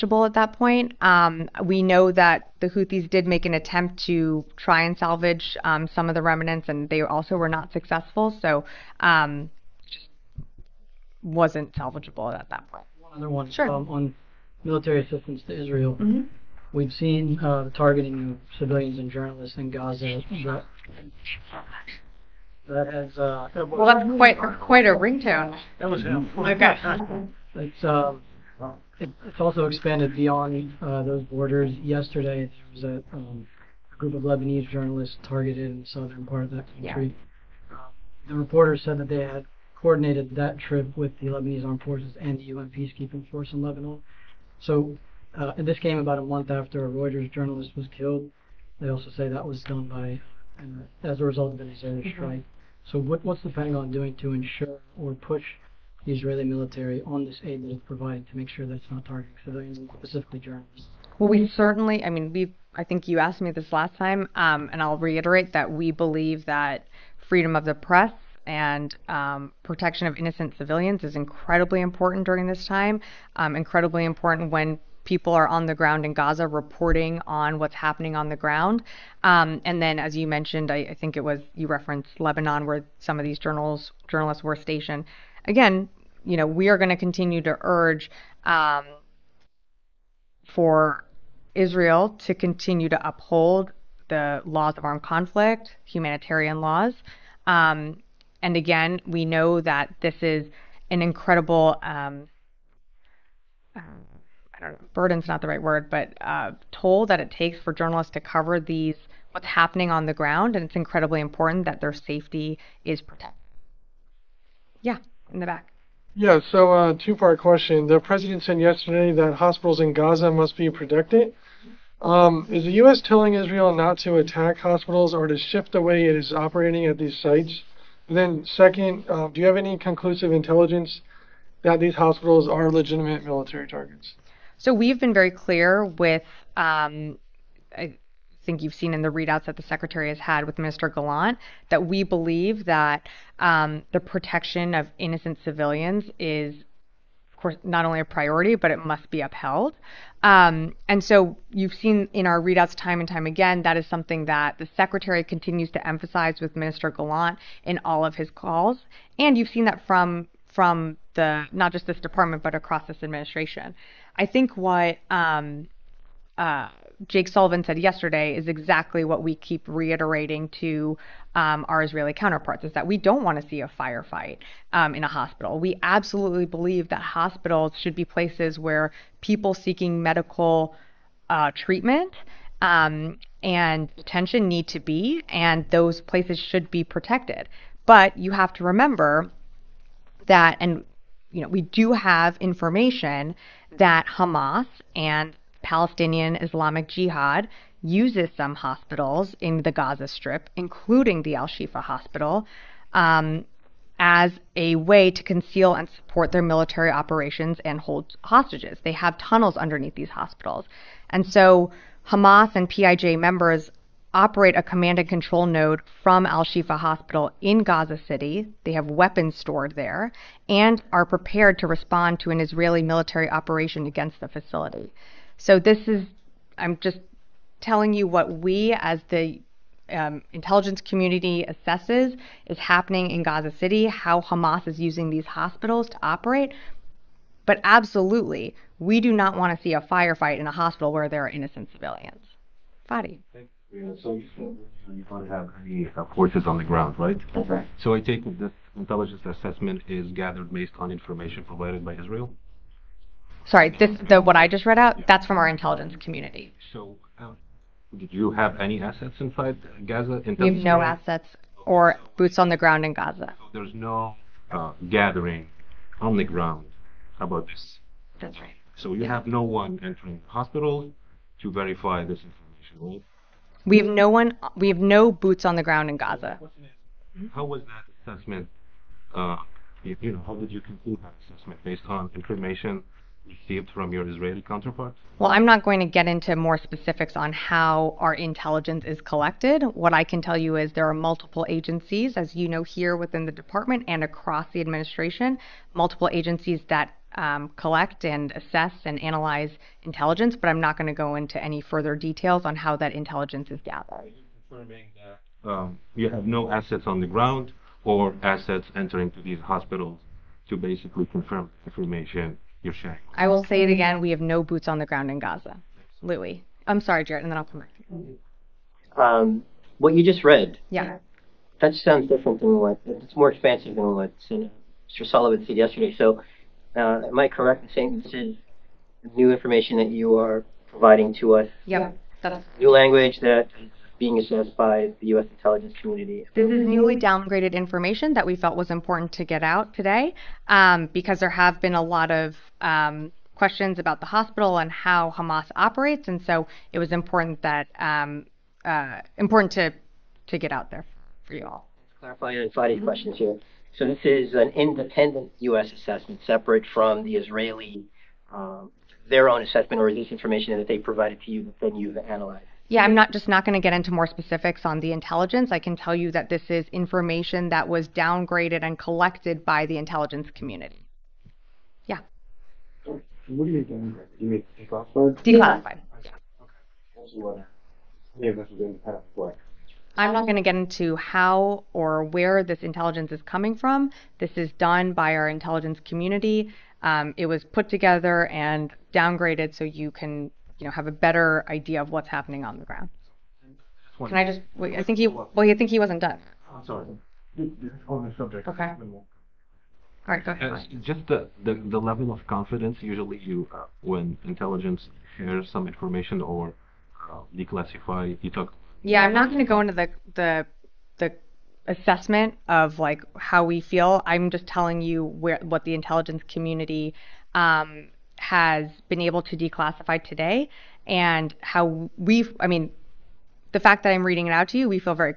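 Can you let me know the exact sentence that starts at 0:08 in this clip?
So, um, just wasn't salvageable at that point.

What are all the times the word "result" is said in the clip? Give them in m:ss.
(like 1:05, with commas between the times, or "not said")
0:51.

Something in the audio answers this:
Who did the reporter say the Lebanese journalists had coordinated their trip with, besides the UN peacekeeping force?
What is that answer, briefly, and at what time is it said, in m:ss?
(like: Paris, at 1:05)
Lebanese armed forces, at 0:41.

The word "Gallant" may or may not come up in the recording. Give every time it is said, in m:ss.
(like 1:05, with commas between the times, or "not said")
2:20, 2:36.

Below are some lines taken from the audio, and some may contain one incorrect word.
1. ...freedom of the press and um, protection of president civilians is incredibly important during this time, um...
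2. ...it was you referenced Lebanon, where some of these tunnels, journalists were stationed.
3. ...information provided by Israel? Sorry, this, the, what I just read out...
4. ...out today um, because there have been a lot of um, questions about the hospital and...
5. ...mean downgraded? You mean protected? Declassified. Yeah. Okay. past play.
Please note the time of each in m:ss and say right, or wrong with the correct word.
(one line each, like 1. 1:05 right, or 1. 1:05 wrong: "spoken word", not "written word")
1. 1:07 wrong: "innocent", not "president"
2. 1:21 wrong: "journals", not "tunnels"
3. 4:10 right
4. 5:39 right
5. 6:13 wrong: "declassified", not "protected".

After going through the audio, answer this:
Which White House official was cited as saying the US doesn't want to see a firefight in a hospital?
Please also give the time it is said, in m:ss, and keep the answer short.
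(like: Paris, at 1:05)
Jake Sullivan, at 2:47.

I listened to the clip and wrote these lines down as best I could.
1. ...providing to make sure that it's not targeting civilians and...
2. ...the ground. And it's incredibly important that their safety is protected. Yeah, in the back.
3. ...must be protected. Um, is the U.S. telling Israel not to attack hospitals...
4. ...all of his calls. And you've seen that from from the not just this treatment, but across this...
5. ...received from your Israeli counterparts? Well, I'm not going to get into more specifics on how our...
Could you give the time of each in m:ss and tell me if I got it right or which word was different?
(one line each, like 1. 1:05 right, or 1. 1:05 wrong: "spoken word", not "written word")
1. 0:57 right
2. 1:50 right
3. 2:00 right
4. 2:37 wrong: "department", not "treatment"
5. 4:43 right.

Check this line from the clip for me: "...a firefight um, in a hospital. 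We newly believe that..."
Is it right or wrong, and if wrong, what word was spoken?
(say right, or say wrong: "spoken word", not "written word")
wrong: "absolutely", not "newly".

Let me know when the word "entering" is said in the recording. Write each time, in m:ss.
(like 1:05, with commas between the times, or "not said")
4:29, 5:08.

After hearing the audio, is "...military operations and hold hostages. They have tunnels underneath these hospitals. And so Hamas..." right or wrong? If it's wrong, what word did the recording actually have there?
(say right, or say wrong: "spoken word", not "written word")
right.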